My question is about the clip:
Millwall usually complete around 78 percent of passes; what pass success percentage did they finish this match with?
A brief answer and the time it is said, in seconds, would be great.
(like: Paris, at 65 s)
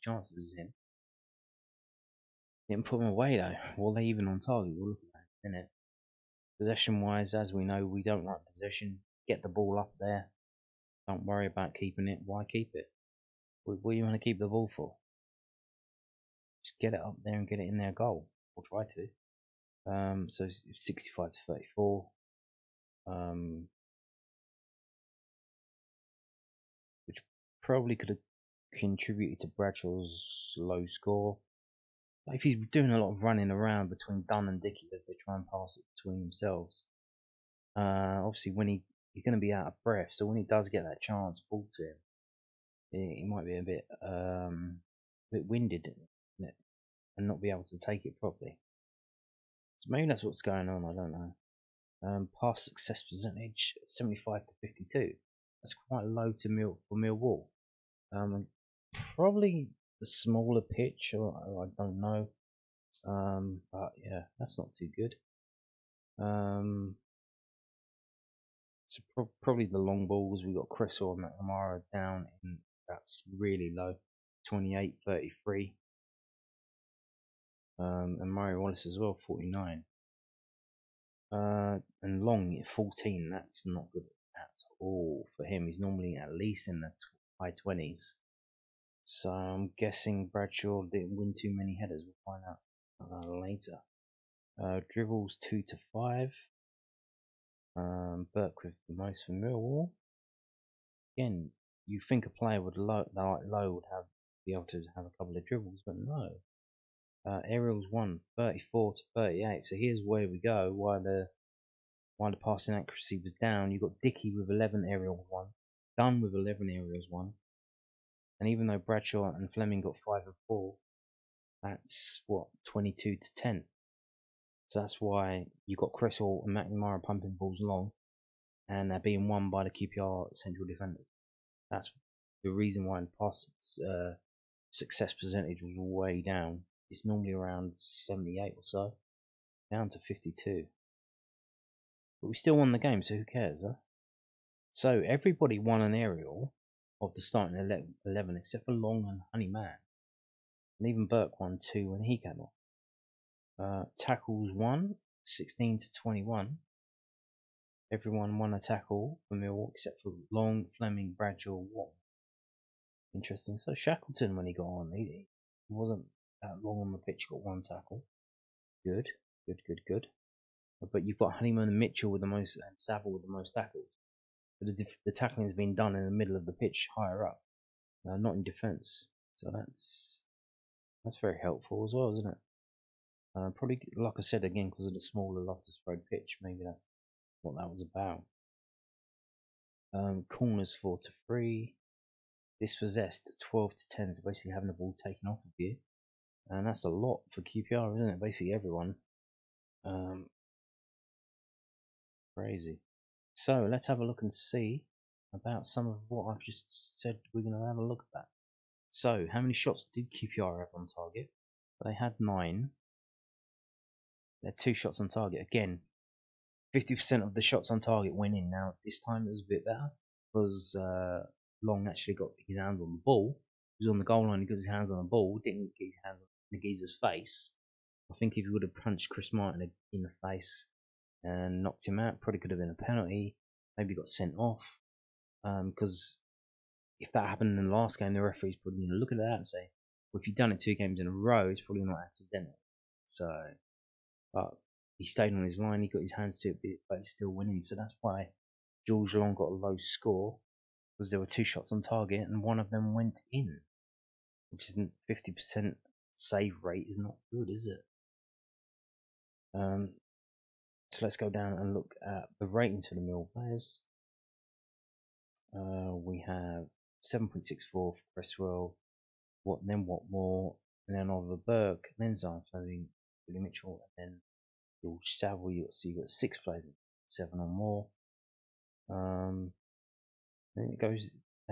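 52, at 139 s.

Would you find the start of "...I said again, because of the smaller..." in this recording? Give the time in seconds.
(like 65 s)
184 s.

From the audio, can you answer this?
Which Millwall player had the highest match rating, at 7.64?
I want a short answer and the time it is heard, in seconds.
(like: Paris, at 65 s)
Cresswell, at 268 s.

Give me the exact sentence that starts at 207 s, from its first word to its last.
We're going to have a look at that.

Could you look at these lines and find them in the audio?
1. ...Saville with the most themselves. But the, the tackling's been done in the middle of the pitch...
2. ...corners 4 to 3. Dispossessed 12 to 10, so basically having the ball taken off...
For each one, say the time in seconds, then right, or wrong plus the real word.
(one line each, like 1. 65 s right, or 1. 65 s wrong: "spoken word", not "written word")
1. 172 s wrong: "tackles", not "themselves"
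2. 190 s right.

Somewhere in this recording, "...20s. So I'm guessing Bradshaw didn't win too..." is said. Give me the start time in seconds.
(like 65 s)
87 s.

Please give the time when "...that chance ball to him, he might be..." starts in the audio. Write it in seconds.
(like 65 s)
40 s.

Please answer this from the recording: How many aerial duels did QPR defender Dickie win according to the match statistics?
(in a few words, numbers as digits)
11.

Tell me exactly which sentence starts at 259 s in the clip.
Um, so let's go down and look at the ratings for the Mill players.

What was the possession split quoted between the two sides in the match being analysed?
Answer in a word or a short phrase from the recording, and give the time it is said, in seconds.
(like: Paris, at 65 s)
65 to 34, at 20 s.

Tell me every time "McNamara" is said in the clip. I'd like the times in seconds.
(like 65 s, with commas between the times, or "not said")
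71 s, 126 s.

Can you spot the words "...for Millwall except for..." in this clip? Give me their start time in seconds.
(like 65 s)
159 s.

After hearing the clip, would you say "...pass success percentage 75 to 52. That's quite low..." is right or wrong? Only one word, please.
right.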